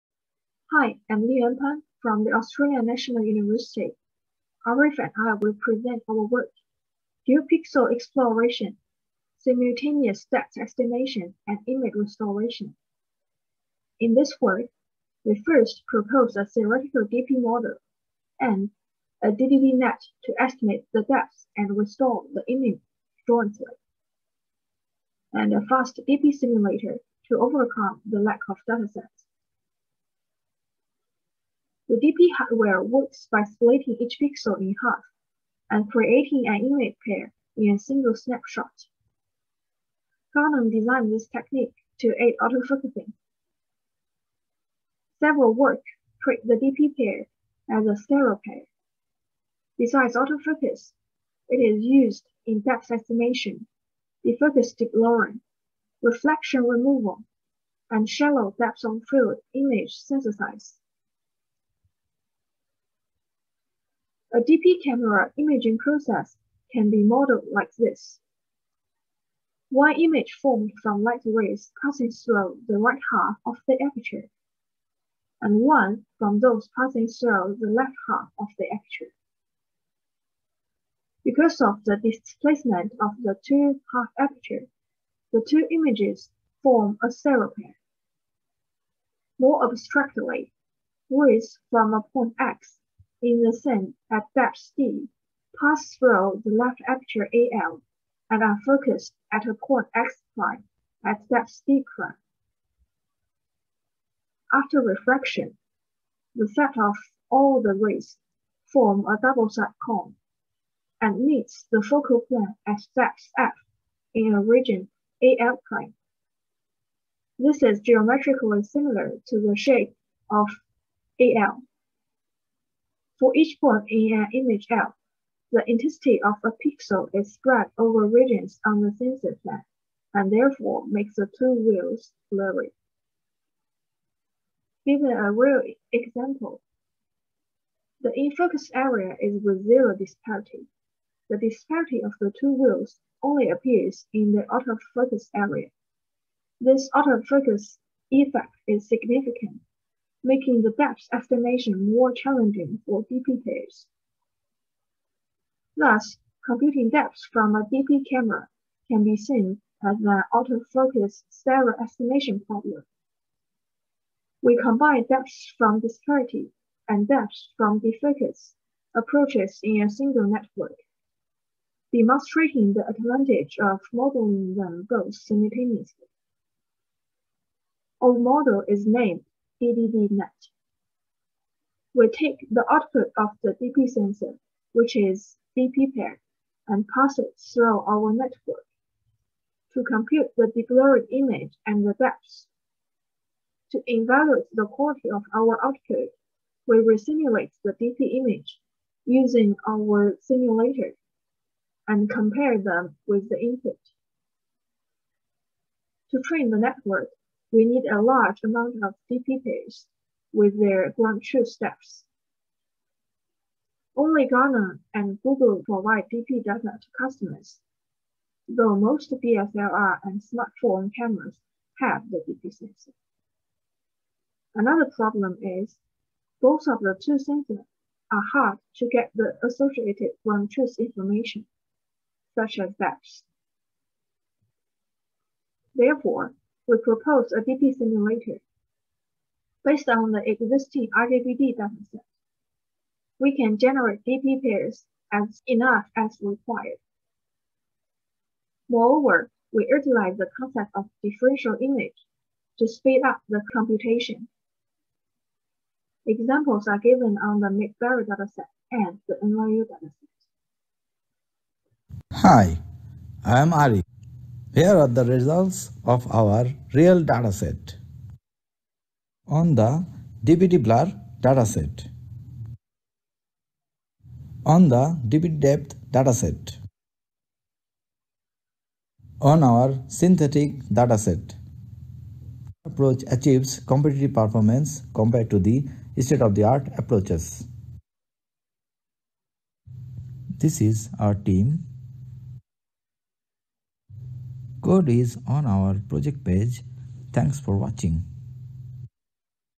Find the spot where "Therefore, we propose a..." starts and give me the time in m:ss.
3:55.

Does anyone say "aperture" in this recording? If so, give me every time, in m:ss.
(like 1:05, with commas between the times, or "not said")
1:13, 1:18, 1:24, 1:36.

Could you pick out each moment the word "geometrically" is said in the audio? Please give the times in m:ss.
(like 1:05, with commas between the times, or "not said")
1:57.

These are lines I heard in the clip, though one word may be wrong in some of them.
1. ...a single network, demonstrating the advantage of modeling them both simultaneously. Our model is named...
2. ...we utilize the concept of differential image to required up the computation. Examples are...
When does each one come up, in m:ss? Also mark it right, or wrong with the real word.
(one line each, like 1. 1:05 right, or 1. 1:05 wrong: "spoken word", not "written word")
1. 2:49 right
2. 4:09 wrong: "speed", not "required".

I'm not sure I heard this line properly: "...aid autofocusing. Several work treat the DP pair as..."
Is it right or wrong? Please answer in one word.
right.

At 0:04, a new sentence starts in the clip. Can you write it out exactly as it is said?
Arif and I will present our work, Pixel Exploration, Simultaneous Depth Estimation and Image Restoration.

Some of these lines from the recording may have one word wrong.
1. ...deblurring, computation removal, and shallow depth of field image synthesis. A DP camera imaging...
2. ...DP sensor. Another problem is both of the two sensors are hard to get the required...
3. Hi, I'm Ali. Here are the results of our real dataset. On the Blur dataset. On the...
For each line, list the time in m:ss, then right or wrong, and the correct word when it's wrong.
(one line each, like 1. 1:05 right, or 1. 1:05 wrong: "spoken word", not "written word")
1. 0:54 wrong: "reflection", not "computation"
2. 3:42 wrong: "associated", not "required"
3. 4:22 right.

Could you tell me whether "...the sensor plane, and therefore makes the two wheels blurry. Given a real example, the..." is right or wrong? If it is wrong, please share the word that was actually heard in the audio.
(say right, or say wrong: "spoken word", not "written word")
right.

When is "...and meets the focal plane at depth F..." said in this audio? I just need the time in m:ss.
1:50.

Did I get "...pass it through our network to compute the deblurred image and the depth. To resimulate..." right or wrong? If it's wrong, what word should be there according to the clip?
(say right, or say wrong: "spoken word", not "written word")
wrong: "evaluate", not "resimulate".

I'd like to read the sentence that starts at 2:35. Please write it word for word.
Thus, computing depths from a DP camera can be seen as an autofocus stereo estimation problem.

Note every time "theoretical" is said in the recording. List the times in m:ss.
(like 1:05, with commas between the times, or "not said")
0:16.